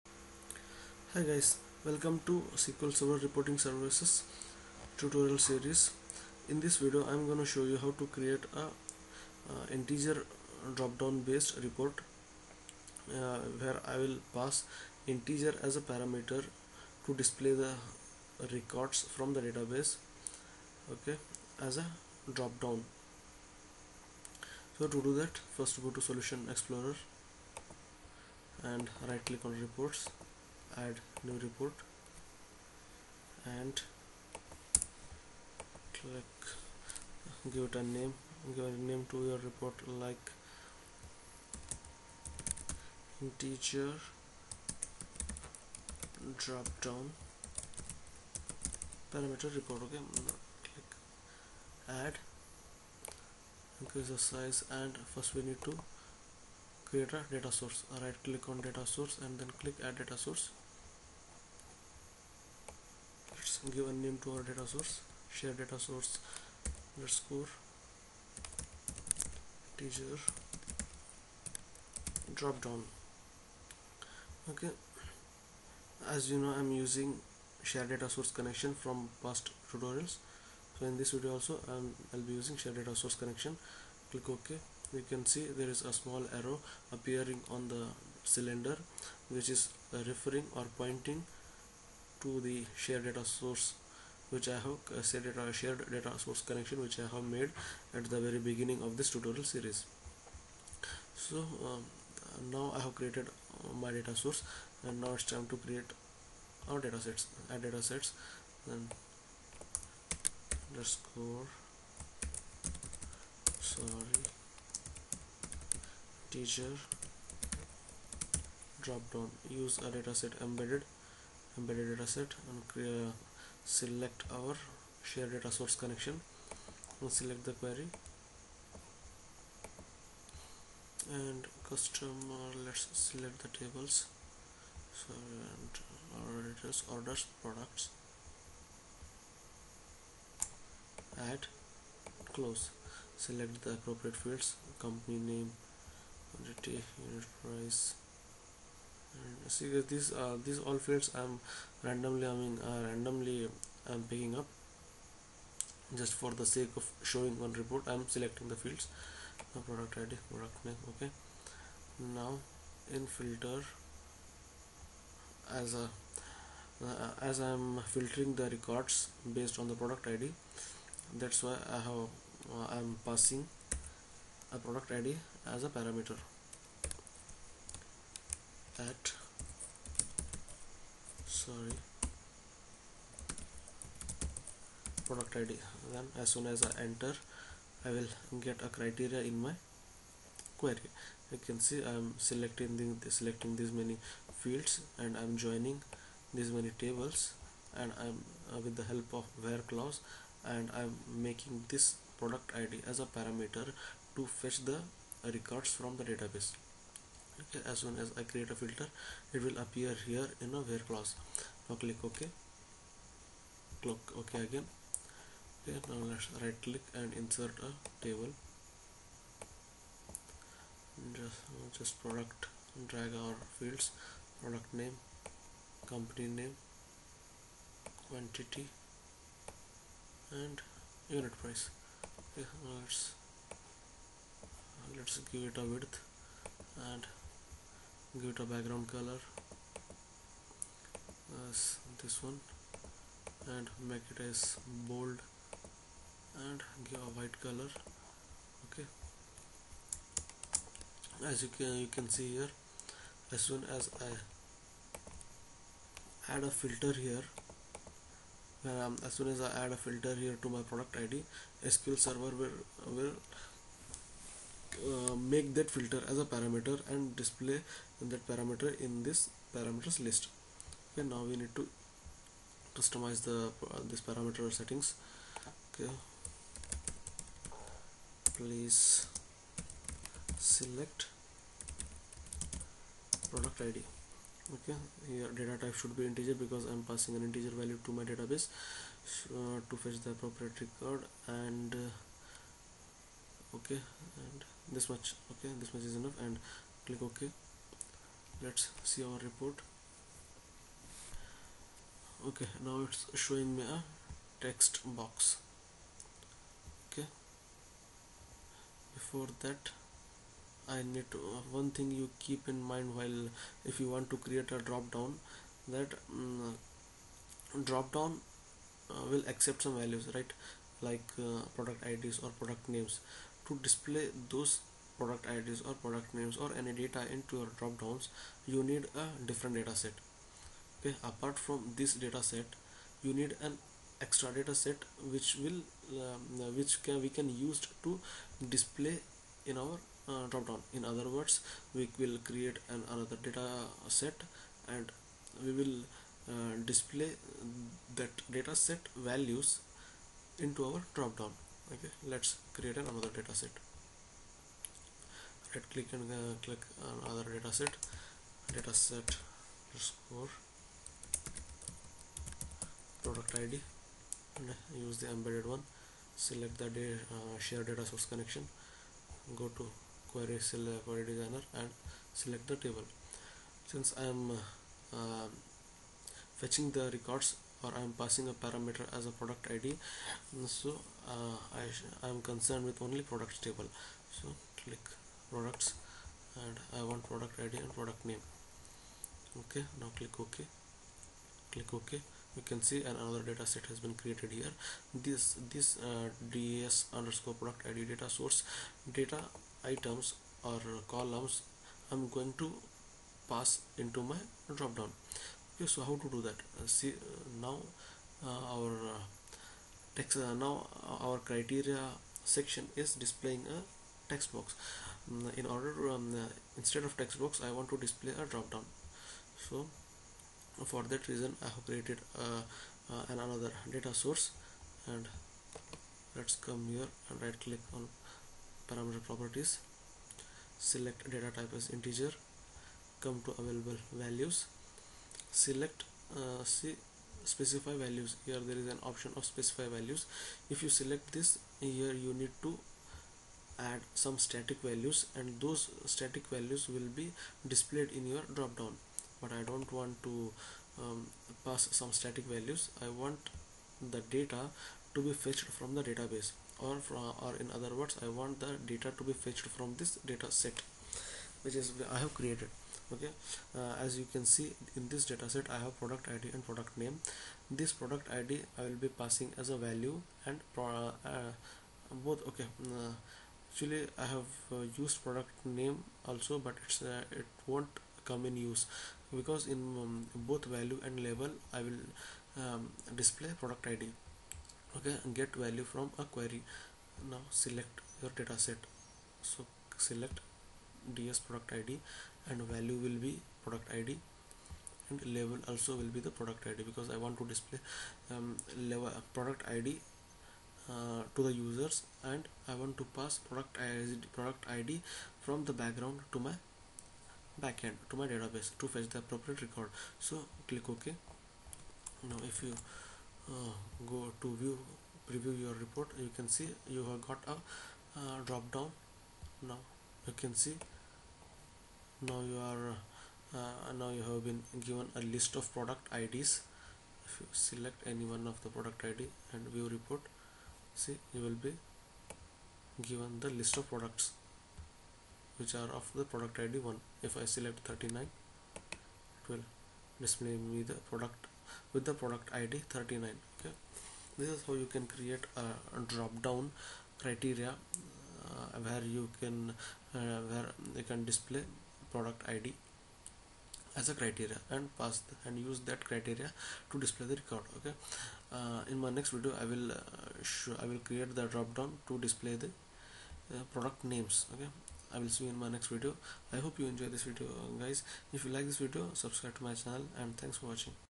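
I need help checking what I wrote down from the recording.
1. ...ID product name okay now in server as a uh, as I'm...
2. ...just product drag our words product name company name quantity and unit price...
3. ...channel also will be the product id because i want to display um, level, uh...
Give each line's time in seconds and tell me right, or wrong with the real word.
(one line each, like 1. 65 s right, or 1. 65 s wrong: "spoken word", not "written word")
1. 159 s wrong: "filter", not "server"
2. 221 s wrong: "fields", not "words"
3. 495 s wrong: "label", not "channel".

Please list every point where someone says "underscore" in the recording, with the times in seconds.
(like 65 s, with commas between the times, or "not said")
66 s, 110 s, 396 s.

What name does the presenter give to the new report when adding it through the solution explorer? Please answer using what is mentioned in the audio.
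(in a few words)
integer drop down parameter report.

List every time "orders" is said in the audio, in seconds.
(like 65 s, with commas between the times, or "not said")
136 s, 415 s.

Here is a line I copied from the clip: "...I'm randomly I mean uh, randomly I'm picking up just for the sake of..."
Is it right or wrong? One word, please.
right.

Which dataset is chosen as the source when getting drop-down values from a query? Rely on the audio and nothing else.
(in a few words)
ds product id.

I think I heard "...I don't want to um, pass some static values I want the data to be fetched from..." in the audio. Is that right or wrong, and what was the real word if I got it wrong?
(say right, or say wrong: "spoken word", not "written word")
right.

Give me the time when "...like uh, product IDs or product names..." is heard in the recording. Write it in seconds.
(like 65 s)
320 s.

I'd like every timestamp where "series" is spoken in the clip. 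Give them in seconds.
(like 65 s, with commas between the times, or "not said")
5 s, 99 s.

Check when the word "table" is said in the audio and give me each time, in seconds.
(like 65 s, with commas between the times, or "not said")
133 s, 196 s, 218 s, 372 s, 383 s.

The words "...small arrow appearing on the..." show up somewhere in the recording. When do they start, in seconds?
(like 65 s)
85 s.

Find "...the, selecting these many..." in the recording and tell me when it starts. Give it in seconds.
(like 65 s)
192 s.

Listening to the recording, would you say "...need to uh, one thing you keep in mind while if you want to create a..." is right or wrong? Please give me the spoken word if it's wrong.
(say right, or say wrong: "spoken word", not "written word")
right.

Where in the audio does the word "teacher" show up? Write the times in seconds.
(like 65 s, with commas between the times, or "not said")
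69 s, 116 s.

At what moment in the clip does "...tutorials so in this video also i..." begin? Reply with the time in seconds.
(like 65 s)
79 s.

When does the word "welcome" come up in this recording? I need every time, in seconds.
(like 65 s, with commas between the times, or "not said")
1 s.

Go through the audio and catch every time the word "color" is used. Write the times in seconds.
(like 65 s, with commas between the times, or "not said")
238 s, 247 s.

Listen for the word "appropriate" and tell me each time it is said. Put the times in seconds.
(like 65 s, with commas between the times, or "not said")
143 s, 290 s, 508 s.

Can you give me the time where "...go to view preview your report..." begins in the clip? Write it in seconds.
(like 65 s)
513 s.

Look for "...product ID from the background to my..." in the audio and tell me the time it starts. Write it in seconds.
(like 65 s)
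504 s.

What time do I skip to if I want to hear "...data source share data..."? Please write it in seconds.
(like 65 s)
64 s.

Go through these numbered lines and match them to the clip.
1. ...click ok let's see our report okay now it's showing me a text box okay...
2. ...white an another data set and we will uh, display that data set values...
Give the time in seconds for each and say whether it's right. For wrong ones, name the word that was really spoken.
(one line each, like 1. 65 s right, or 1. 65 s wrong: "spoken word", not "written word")
1. 296 s right
2. 342 s wrong: "create", not "white".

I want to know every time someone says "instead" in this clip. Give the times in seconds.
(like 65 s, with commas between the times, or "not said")
416 s.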